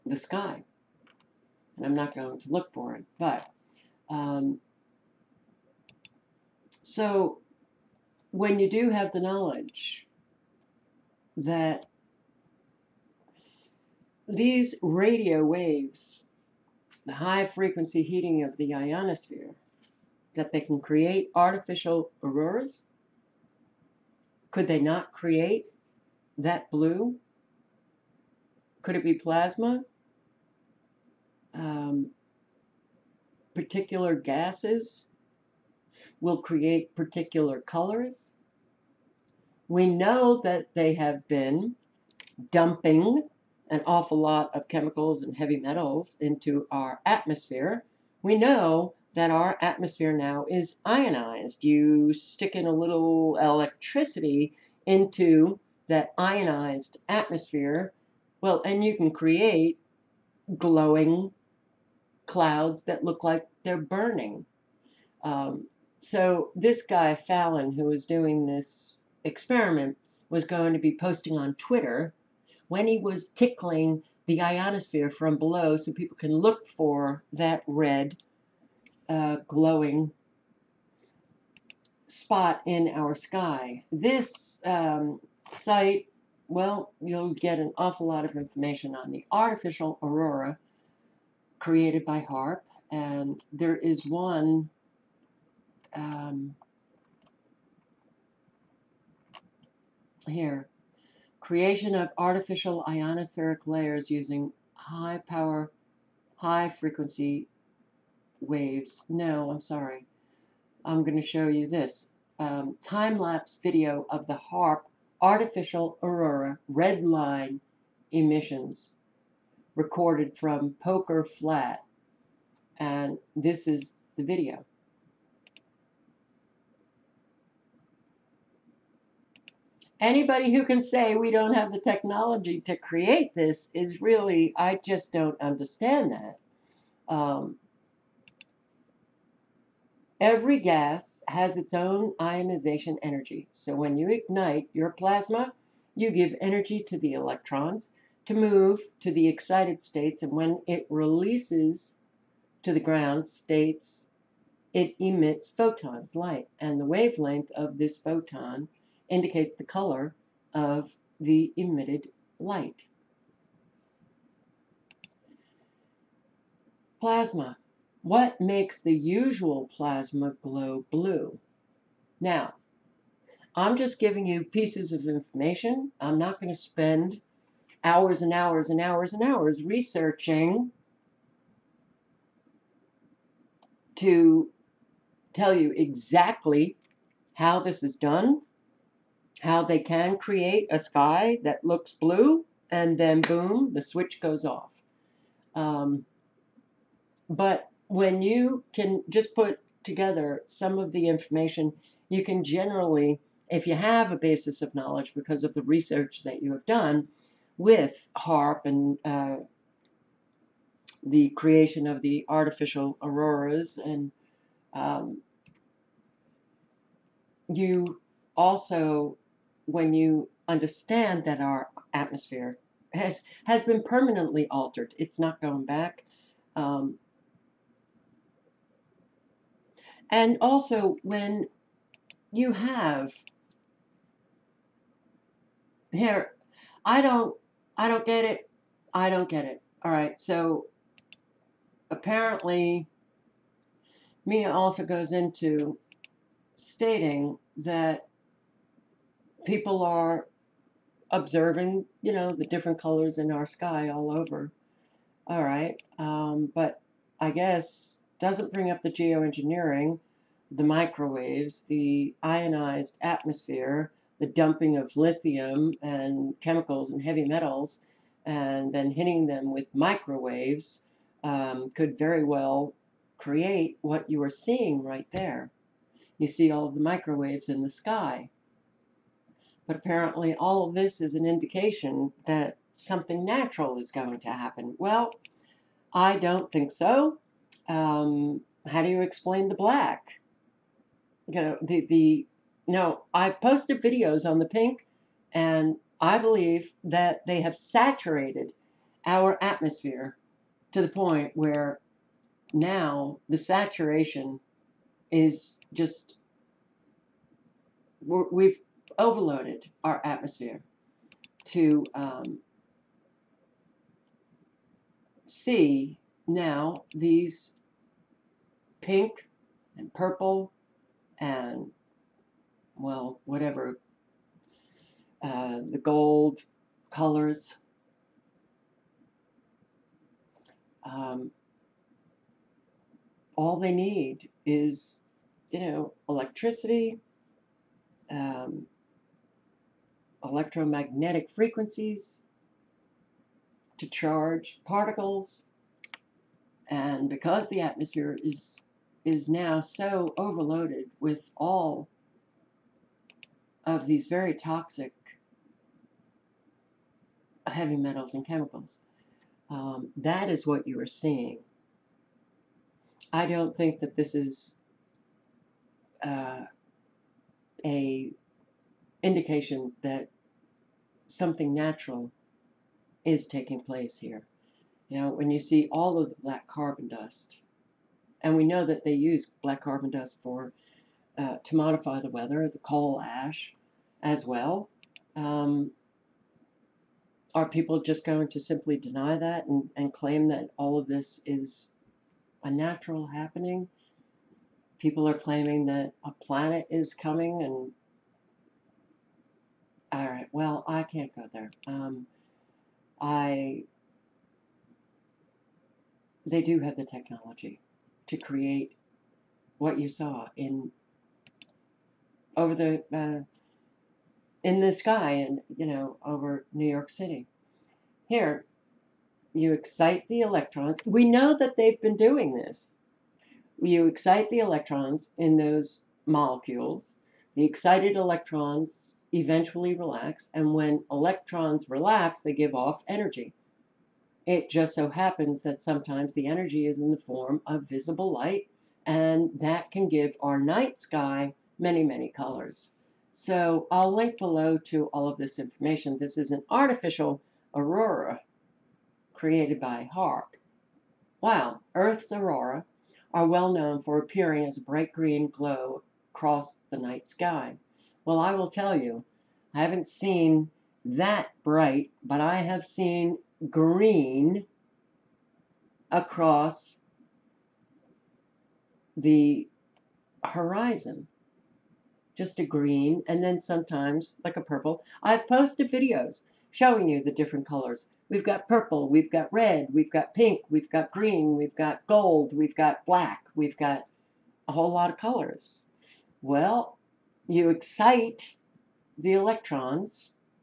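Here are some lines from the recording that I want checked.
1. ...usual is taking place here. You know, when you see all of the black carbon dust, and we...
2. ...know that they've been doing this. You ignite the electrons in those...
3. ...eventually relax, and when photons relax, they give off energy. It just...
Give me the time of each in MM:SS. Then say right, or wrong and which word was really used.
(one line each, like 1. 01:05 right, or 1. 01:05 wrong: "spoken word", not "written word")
1. 06:11 wrong: "natural", not "usual"
2. 07:01 wrong: "excite", not "ignite"
3. 07:09 wrong: "electrons", not "photons".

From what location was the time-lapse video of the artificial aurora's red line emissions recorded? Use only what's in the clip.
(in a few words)
Poker Flat.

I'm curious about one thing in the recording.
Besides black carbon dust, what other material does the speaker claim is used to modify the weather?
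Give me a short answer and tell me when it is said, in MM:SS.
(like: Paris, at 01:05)
Coal ash, at 06:22.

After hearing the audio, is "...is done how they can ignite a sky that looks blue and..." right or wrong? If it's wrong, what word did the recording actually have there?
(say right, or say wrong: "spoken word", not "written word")
wrong: "create", not "ignite".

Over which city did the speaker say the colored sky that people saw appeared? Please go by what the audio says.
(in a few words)
New York City.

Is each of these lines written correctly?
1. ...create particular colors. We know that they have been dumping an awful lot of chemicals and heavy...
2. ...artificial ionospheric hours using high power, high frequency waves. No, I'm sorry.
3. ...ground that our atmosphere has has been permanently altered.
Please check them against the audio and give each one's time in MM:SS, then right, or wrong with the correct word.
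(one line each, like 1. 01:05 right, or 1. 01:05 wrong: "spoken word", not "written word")
1. 00:36 right
2. 01:42 wrong: "layers", not "hours"
3. 03:40 wrong: "understand", not "ground".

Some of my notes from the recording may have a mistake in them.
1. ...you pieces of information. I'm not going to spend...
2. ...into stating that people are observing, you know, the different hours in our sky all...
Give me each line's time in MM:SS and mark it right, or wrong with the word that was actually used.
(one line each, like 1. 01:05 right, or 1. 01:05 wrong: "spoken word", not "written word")
1. 02:54 right
2. 04:05 wrong: "colors", not "hours".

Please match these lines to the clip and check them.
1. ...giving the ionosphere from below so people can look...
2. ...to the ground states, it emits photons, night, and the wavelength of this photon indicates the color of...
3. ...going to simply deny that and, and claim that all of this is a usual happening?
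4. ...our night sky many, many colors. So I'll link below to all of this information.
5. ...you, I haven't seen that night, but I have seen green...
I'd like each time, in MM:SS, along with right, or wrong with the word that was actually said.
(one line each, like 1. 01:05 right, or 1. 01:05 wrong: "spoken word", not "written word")
1. 01:13 wrong: "tickling", not "giving"
2. 02:32 wrong: "light", not "night"
3. 06:28 wrong: "natural", not "usual"
4. 07:20 right
5. 07:38 wrong: "bright", not "night".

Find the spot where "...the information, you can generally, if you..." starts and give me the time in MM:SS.
03:20.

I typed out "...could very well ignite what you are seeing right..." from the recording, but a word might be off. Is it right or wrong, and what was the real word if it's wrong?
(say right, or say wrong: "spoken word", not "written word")
wrong: "create", not "ignite".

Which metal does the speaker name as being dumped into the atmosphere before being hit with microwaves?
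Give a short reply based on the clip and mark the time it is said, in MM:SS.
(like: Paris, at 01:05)
Lithium, at 04:24.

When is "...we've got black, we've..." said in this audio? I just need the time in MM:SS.
08:02.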